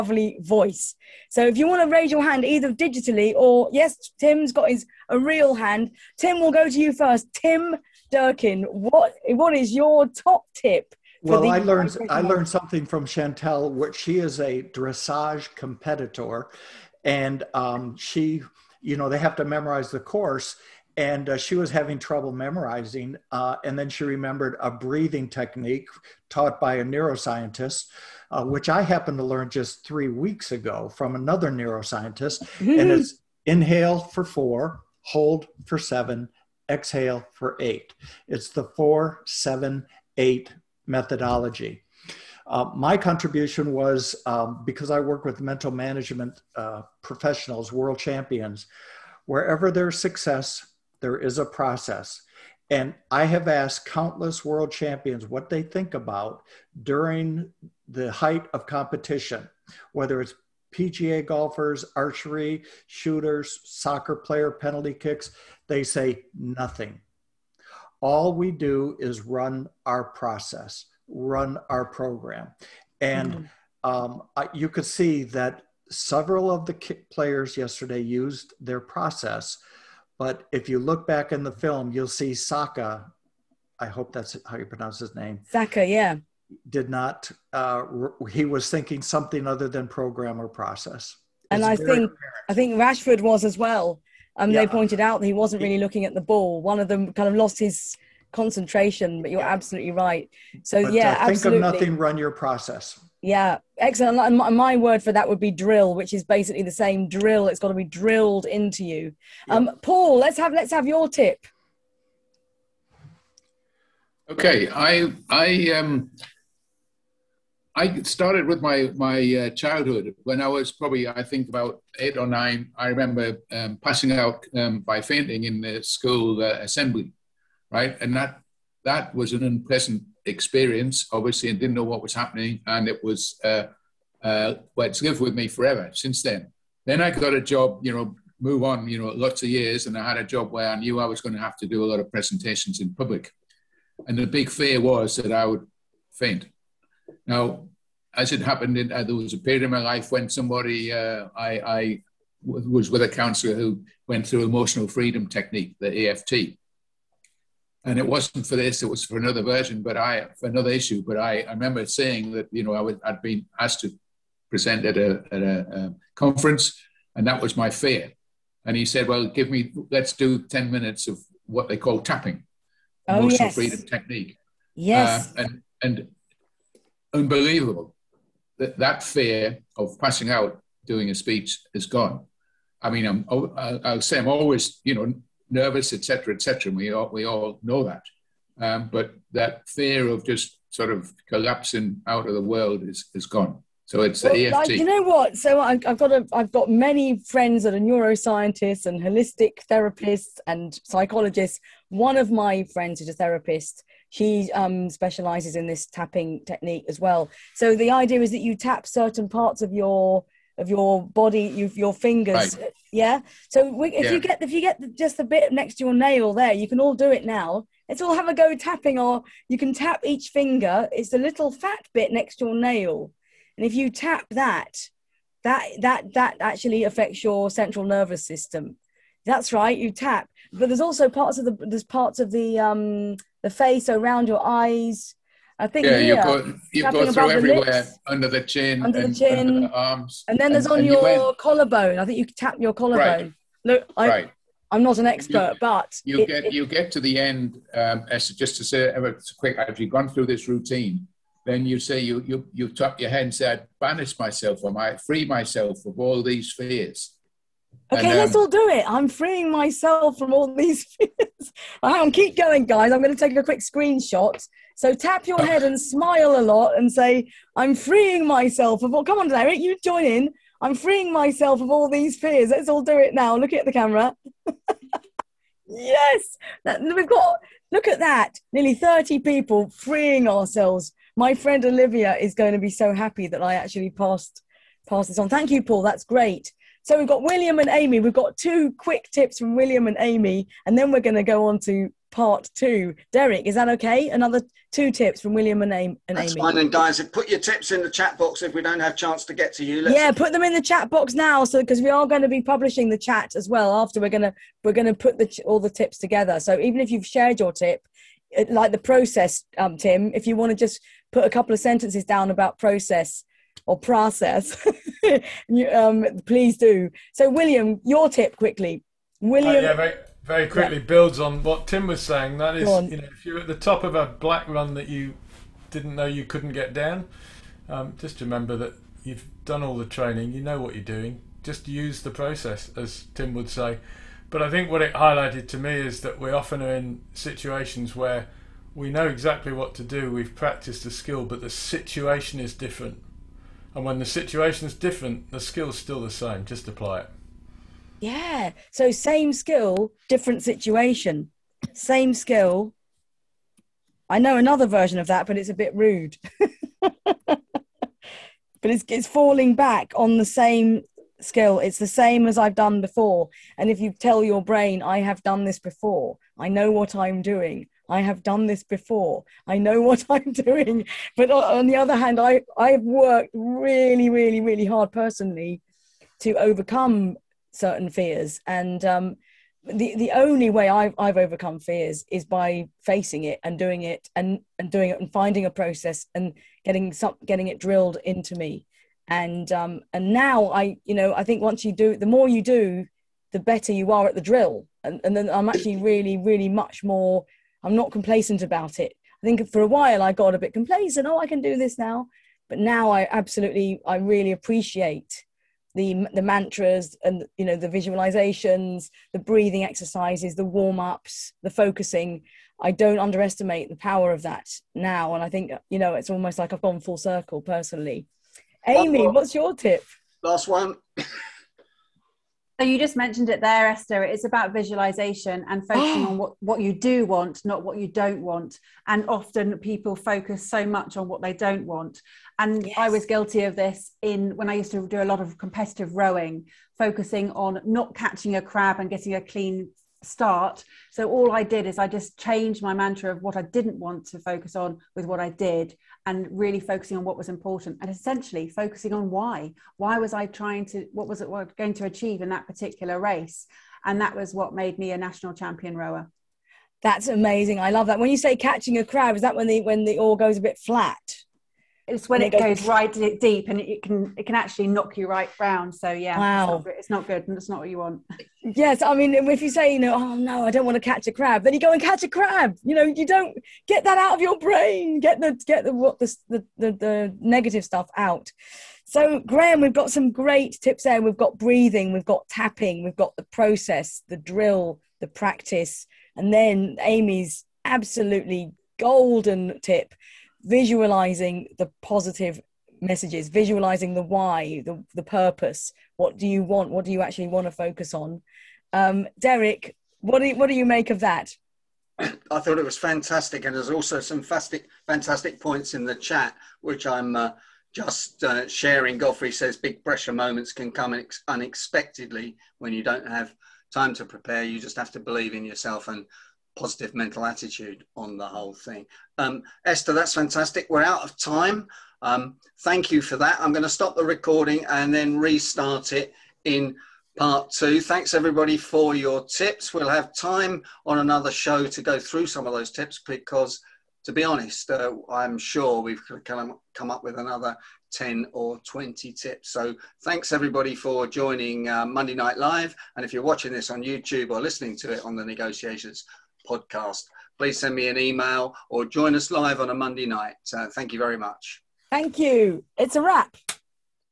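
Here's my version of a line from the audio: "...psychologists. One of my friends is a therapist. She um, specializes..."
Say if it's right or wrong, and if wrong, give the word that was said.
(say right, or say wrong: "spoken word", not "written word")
right.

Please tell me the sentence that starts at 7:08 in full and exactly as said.
And often people focus so much on what they don't want.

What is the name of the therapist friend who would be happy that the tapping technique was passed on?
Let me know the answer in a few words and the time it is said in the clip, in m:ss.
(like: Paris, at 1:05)
Olivia, at 4:41.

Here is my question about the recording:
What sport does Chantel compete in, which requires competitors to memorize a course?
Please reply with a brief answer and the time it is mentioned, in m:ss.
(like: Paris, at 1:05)
Dressage, at 0:14.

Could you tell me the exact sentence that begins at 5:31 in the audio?
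Just use the process, as Tim would say.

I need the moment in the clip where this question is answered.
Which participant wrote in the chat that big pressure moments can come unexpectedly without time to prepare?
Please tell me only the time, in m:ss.
8:28.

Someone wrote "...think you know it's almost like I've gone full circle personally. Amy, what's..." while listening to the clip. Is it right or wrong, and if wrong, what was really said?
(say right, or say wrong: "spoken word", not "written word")
right.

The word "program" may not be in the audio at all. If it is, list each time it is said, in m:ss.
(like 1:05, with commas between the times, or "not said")
1:11, 1:29.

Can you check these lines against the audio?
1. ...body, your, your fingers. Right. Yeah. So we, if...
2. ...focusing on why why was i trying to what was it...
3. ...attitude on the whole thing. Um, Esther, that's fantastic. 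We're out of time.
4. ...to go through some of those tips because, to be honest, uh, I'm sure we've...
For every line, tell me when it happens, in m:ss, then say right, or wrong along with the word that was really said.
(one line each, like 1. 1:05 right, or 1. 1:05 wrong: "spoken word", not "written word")
1. 3:31 right
2. 7:28 right
3. 8:37 right
4. 8:51 right.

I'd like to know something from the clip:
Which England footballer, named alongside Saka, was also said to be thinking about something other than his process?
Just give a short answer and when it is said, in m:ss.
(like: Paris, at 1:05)
Rashford, at 1:32.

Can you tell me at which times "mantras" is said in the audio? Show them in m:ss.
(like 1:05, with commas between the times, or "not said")
6:46, 7:22.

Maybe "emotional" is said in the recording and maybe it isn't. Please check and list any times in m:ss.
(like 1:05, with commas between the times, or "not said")
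2:34, 2:53.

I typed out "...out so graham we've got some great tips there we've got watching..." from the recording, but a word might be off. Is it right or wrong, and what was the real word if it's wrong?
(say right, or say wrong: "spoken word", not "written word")
wrong: "breathing", not "watching".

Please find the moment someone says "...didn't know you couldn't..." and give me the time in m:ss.
5:25.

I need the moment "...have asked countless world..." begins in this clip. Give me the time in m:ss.
0:53.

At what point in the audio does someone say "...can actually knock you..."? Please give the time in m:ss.
7:44.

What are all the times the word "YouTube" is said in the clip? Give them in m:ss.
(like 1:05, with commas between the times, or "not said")
9:03.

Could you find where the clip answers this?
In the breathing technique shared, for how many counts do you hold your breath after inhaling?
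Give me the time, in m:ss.
0:35.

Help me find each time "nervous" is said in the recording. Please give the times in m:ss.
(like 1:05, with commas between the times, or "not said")
3:05, 3:47.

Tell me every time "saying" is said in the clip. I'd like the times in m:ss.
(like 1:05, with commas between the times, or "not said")
2:41, 5:22.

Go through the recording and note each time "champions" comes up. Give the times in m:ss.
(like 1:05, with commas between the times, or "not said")
0:47, 0:54, 7:35.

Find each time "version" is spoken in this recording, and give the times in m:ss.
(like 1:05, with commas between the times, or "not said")
2:39, 5:54.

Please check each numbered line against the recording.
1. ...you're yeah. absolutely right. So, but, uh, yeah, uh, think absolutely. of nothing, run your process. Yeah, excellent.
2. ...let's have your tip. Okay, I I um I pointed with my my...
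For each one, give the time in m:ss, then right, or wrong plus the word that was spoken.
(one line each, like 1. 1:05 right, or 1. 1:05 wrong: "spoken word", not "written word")
1. 1:39 right
2. 1:50 wrong: "started", not "pointed".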